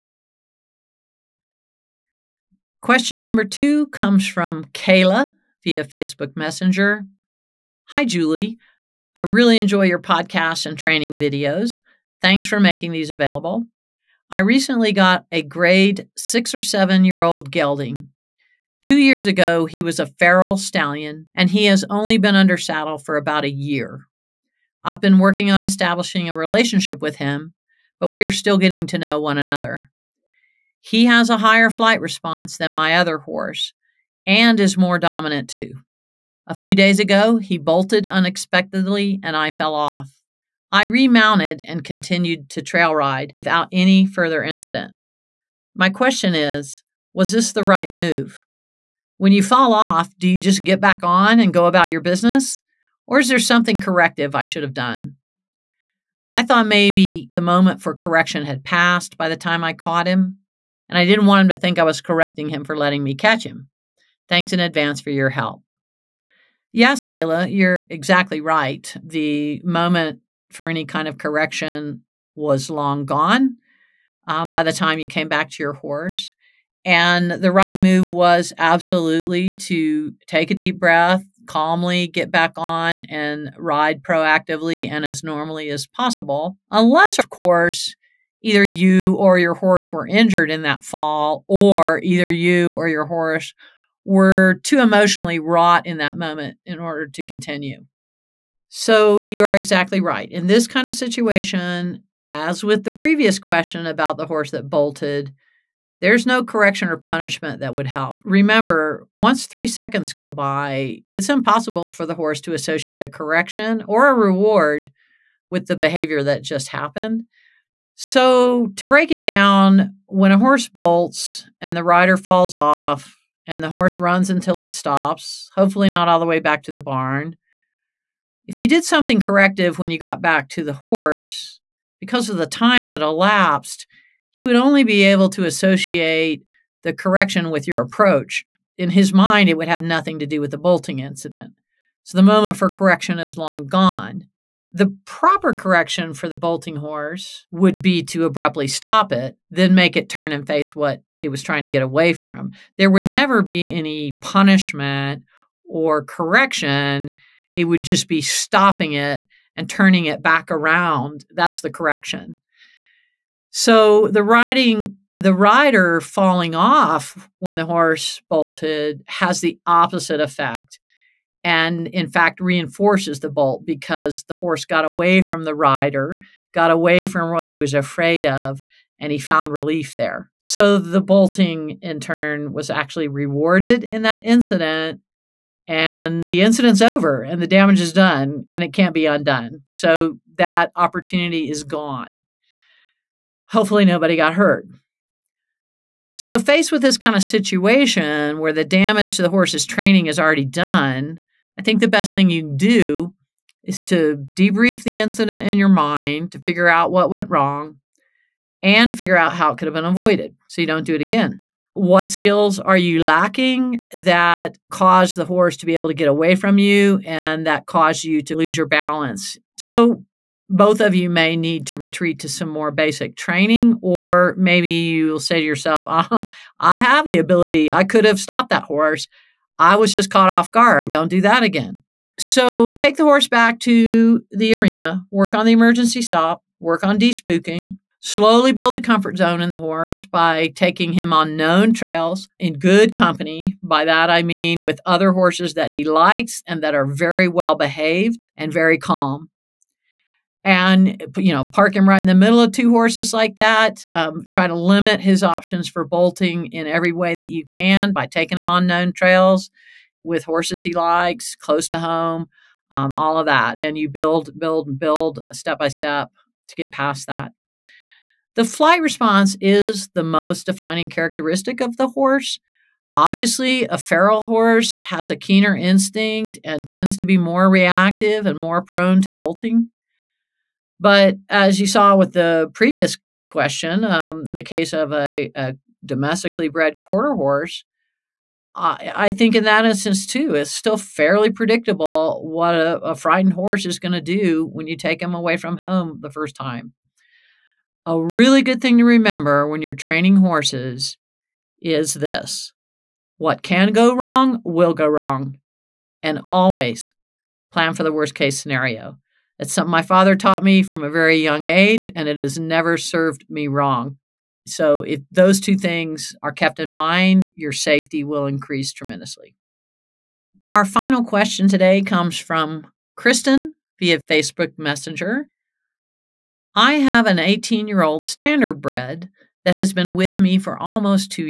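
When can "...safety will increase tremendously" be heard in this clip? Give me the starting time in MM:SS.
05:17.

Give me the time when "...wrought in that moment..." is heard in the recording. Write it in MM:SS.
01:35.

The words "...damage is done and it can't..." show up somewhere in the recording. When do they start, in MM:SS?
03:07.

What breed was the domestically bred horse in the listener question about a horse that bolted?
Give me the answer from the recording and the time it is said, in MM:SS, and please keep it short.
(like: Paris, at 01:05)
Quarter horse, at 04:46.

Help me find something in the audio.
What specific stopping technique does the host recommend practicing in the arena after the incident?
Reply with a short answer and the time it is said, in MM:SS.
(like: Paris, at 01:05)
emergency stop, at 03:55.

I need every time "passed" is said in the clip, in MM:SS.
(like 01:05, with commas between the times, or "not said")
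00:58.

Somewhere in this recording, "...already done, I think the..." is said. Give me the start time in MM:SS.
03:20.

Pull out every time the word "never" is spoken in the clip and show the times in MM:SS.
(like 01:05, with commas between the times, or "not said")
02:33, 05:12.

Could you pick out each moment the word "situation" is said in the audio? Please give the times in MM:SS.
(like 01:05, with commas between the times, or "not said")
01:40, 03:17.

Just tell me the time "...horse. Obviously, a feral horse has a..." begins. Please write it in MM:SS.
04:31.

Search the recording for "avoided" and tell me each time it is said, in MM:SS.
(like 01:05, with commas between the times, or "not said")
03:29.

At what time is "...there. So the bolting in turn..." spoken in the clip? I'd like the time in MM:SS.
02:59.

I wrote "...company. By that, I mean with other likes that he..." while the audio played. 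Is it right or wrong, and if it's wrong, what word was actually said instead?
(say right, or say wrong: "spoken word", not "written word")
wrong: "horses", not "likes".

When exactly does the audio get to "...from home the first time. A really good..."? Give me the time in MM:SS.
04:55.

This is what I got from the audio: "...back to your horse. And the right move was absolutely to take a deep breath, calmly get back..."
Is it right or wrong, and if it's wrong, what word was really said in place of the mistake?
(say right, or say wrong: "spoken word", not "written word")
right.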